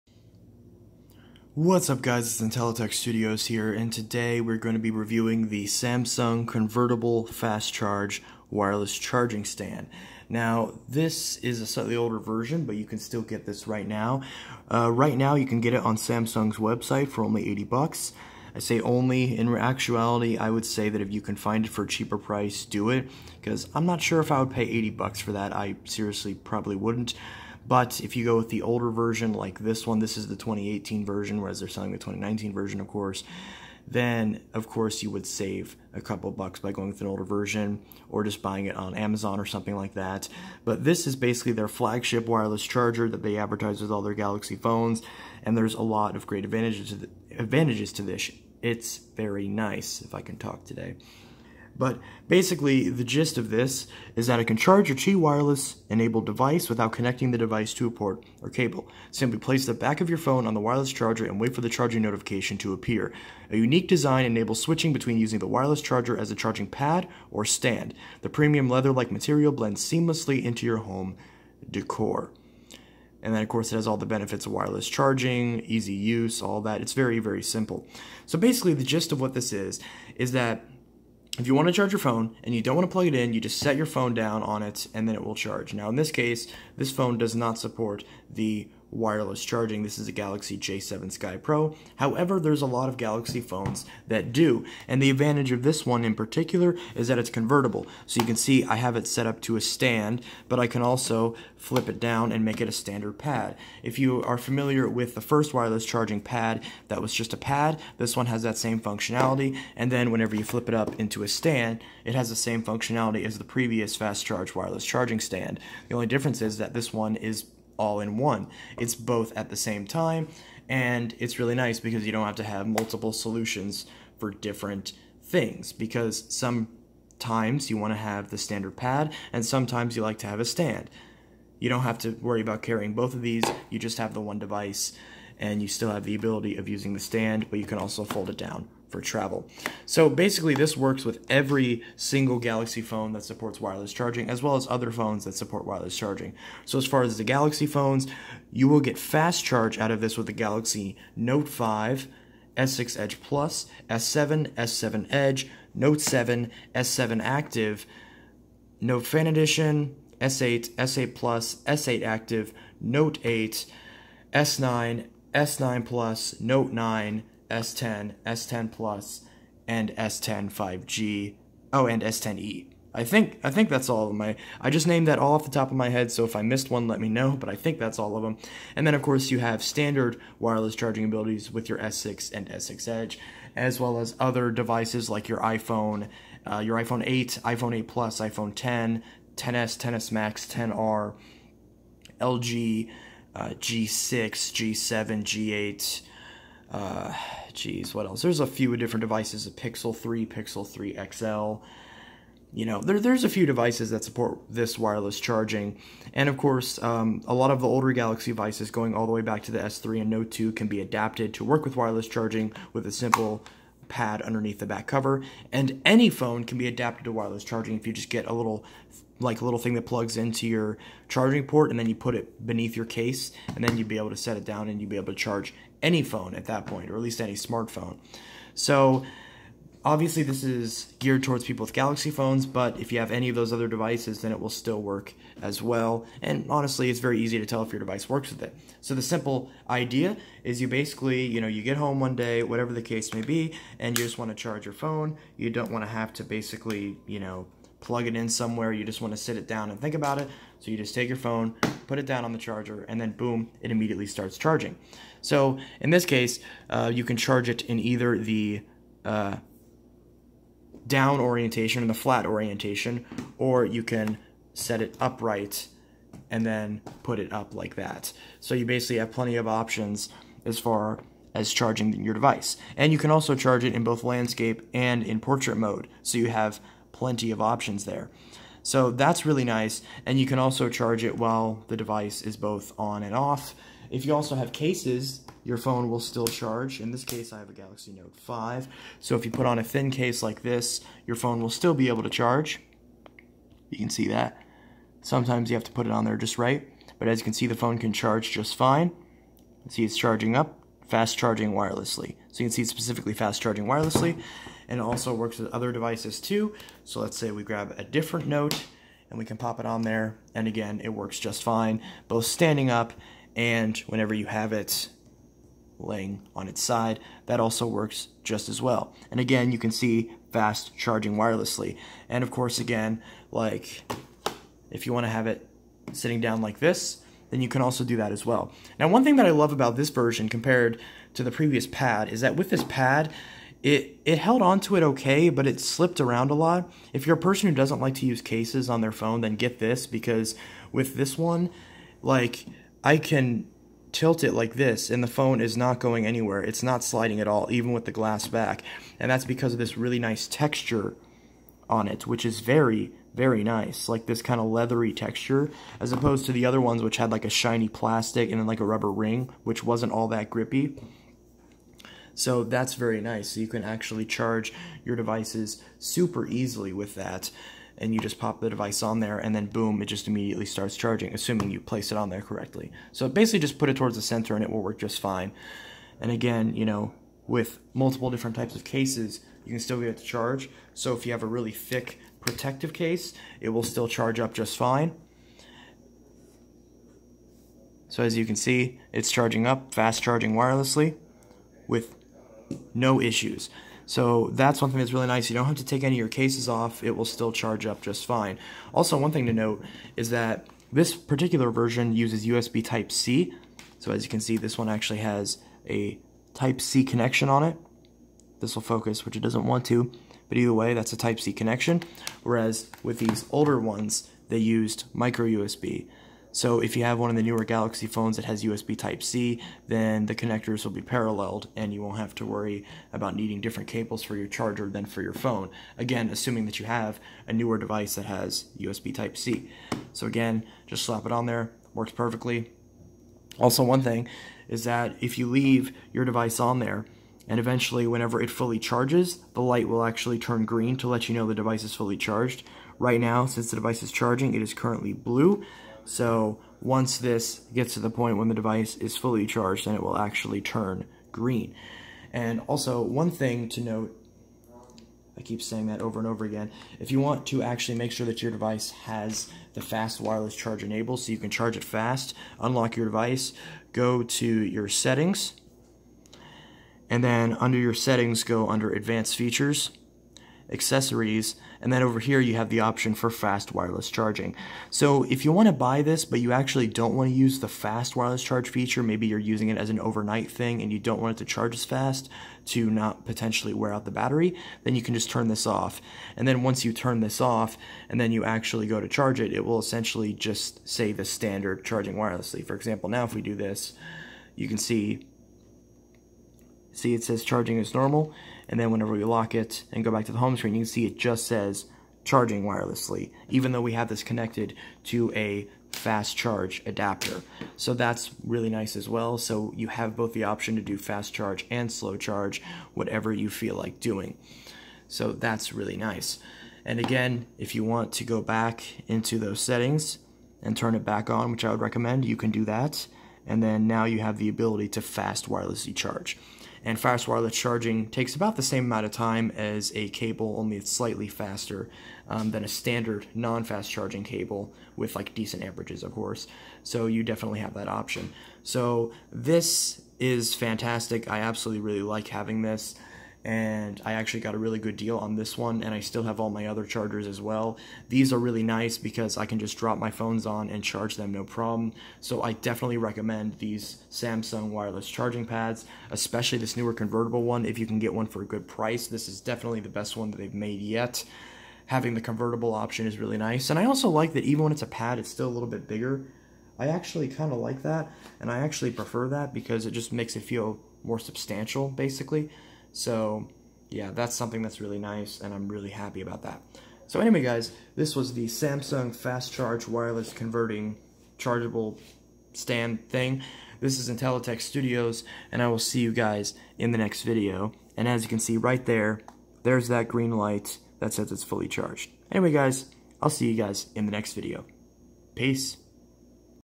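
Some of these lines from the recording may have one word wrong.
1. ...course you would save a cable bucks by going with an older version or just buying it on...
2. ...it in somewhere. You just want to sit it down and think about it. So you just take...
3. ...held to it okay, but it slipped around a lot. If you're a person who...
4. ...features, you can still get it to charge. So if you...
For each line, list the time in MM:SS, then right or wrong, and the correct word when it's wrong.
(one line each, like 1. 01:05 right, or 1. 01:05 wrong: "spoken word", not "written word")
1. 00:34 wrong: "couple", not "cable"
2. 04:08 right
3. 05:34 right
4. 06:18 wrong: "cases", not "features".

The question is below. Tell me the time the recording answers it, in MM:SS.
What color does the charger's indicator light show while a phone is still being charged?
07:24.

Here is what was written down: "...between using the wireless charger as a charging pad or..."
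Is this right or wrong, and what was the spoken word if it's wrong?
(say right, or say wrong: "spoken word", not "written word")
right.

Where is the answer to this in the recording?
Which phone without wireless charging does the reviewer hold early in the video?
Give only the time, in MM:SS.
01:30.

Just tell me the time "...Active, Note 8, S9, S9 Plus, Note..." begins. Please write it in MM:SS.
02:42.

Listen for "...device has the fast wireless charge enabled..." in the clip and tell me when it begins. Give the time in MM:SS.
07:38.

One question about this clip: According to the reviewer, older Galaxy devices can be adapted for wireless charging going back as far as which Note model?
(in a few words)
Note 2.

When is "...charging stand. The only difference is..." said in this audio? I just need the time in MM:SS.
01:54.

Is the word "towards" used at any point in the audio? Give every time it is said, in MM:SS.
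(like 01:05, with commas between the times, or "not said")
03:51, 06:13.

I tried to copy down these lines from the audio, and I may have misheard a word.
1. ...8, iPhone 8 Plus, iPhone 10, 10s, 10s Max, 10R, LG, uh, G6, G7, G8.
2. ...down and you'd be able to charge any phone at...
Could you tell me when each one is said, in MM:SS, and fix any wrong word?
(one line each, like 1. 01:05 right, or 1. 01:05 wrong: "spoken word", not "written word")
1. 03:07 right
2. 03:44 right.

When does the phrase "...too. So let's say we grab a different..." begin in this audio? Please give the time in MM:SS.
05:06.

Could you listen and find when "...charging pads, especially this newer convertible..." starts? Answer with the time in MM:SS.
09:14.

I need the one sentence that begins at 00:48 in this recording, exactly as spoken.
It's very nice, if I can talk today.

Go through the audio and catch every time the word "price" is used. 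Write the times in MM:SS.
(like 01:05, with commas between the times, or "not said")
00:22, 09:18.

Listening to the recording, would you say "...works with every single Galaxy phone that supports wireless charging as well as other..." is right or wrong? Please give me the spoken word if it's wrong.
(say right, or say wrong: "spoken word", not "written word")
right.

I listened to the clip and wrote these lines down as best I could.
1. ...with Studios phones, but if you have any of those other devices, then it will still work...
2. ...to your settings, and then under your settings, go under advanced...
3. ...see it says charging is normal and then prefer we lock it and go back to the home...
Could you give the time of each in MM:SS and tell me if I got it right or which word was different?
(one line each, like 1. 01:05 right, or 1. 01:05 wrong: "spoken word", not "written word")
1. 03:51 wrong: "Galaxy", not "Studios"
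2. 07:44 right
3. 08:16 wrong: "whenever", not "prefer".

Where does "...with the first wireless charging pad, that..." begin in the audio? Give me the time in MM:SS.
01:44.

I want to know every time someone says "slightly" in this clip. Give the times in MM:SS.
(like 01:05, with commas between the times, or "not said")
00:11, 08:50.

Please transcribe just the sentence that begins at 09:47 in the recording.
And as you can see right there, there's that green light that says it's fully charged.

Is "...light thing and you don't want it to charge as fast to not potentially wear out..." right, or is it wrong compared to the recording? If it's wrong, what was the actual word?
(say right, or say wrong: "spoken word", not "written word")
wrong: "overnight", not "light".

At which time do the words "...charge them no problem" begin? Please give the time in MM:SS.
09:10.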